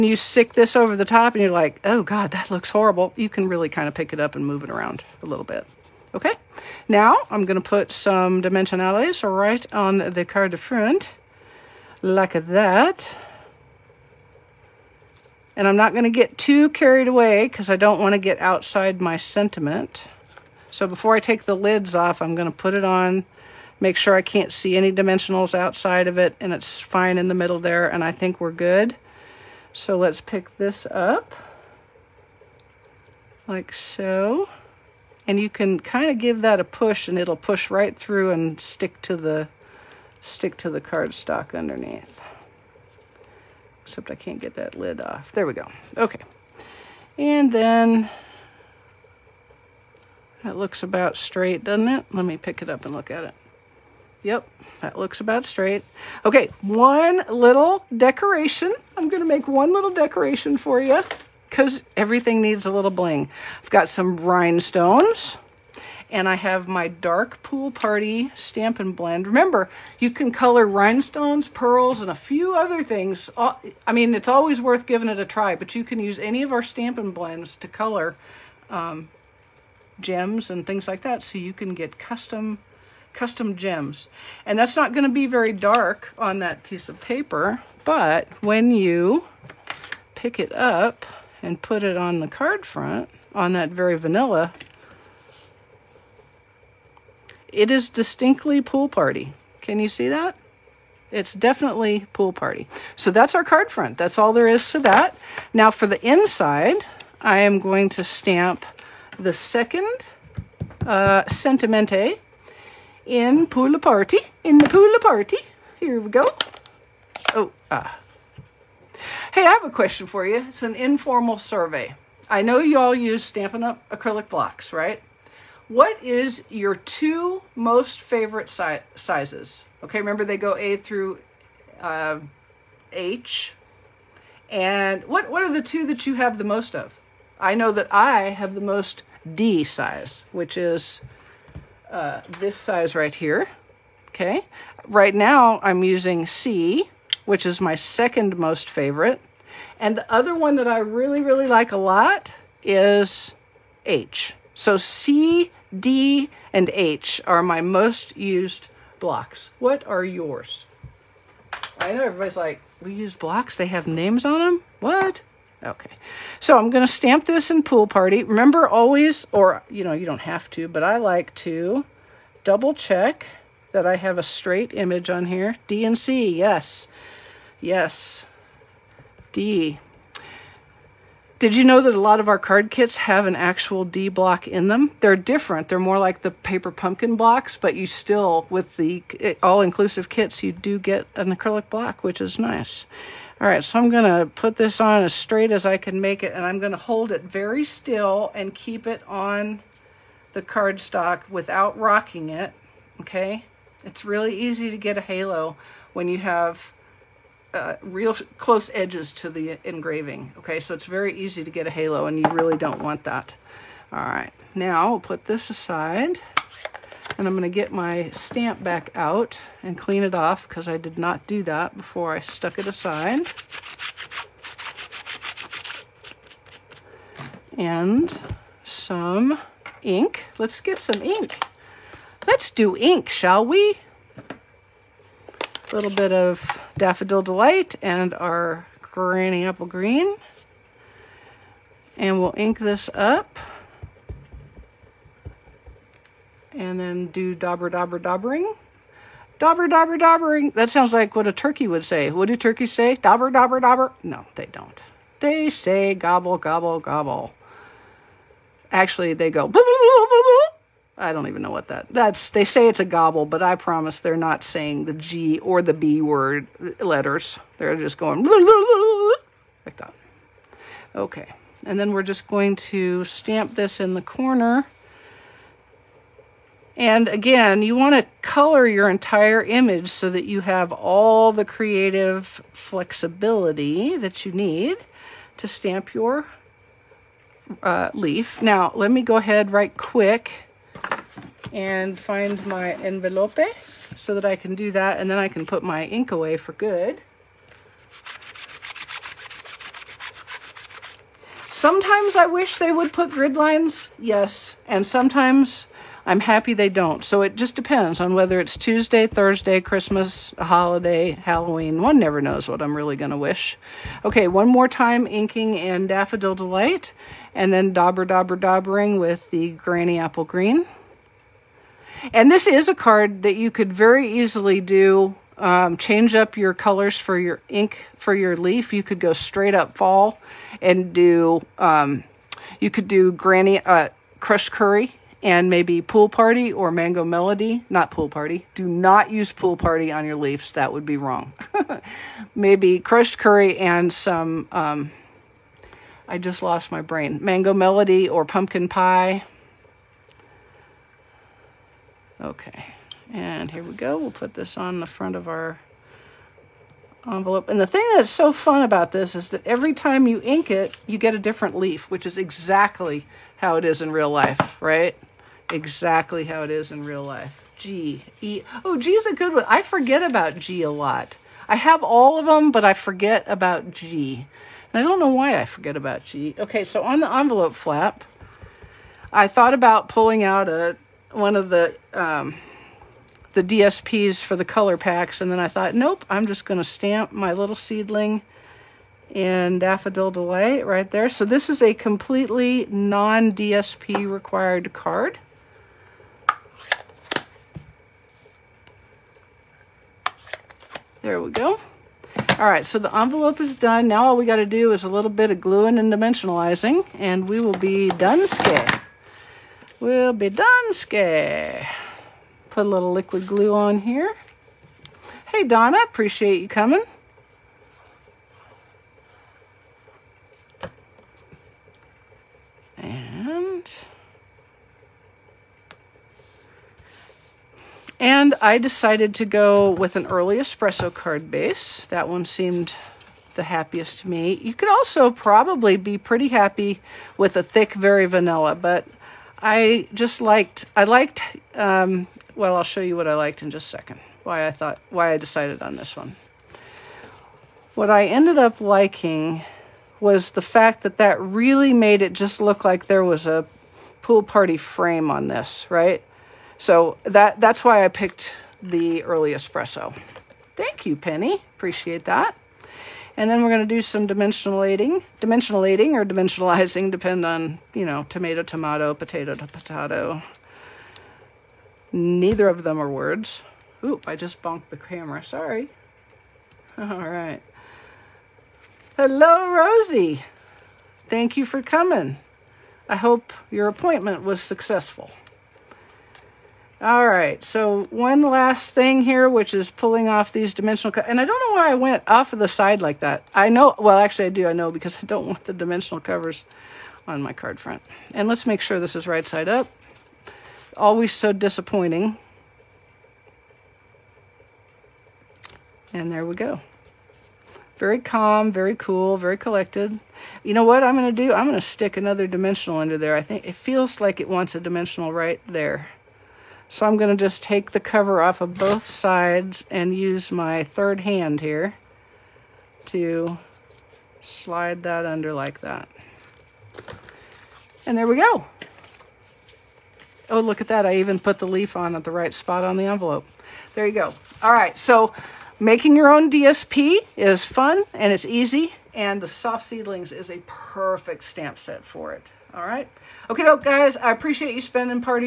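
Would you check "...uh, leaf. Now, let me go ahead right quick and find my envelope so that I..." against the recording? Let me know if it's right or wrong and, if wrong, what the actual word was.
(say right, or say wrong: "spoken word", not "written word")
right.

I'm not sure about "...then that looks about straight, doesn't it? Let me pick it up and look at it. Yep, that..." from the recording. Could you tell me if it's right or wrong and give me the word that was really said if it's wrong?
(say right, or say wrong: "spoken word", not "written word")
right.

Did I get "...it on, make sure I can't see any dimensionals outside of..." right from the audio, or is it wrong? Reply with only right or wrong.
right.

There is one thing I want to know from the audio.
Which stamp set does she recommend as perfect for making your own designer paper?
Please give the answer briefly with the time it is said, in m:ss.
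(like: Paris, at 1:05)
Soft Seedlings, at 8:59.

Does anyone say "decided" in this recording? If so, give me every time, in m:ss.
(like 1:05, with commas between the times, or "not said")
7:08, 7:25.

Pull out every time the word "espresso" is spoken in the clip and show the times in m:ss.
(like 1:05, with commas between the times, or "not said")
7:10, 7:39.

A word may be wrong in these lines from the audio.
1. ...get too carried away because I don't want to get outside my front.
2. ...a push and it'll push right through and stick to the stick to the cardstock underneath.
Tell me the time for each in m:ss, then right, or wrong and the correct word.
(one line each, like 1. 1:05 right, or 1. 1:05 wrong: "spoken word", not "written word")
1. 0:16 wrong: "sentiment", not "front"
2. 0:36 right.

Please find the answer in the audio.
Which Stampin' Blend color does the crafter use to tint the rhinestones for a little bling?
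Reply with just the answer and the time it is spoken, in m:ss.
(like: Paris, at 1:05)
Dark Pool Party, at 1:06.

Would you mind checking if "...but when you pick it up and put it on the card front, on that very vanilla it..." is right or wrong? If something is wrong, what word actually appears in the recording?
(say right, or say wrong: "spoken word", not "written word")
right.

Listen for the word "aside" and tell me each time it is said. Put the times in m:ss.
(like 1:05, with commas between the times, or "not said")
3:35, 3:42.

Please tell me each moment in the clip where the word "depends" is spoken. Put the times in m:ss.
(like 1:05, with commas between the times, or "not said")
5:07, 7:46.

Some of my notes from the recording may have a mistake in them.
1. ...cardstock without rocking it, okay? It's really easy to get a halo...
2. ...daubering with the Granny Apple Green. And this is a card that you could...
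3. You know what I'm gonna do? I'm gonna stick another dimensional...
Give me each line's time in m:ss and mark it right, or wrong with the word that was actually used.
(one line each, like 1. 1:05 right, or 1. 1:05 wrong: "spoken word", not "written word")
1. 3:20 right
2. 5:18 right
3. 8:30 right.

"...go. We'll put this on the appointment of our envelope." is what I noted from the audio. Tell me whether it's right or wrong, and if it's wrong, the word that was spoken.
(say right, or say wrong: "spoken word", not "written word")
wrong: "front", not "appointment".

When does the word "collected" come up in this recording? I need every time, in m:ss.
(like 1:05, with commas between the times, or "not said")
8:29.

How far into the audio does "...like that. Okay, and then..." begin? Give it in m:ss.
4:29.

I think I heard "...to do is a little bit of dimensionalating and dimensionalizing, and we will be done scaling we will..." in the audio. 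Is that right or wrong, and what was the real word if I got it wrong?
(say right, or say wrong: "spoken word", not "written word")
wrong: "gluing", not "dimensionalating".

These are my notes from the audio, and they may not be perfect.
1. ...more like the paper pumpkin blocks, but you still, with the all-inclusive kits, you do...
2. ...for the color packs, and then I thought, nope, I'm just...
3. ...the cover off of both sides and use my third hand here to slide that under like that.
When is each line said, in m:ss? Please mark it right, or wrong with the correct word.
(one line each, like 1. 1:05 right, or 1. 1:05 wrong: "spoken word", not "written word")
1. 3:05 right
2. 6:24 right
3. 8:37 right.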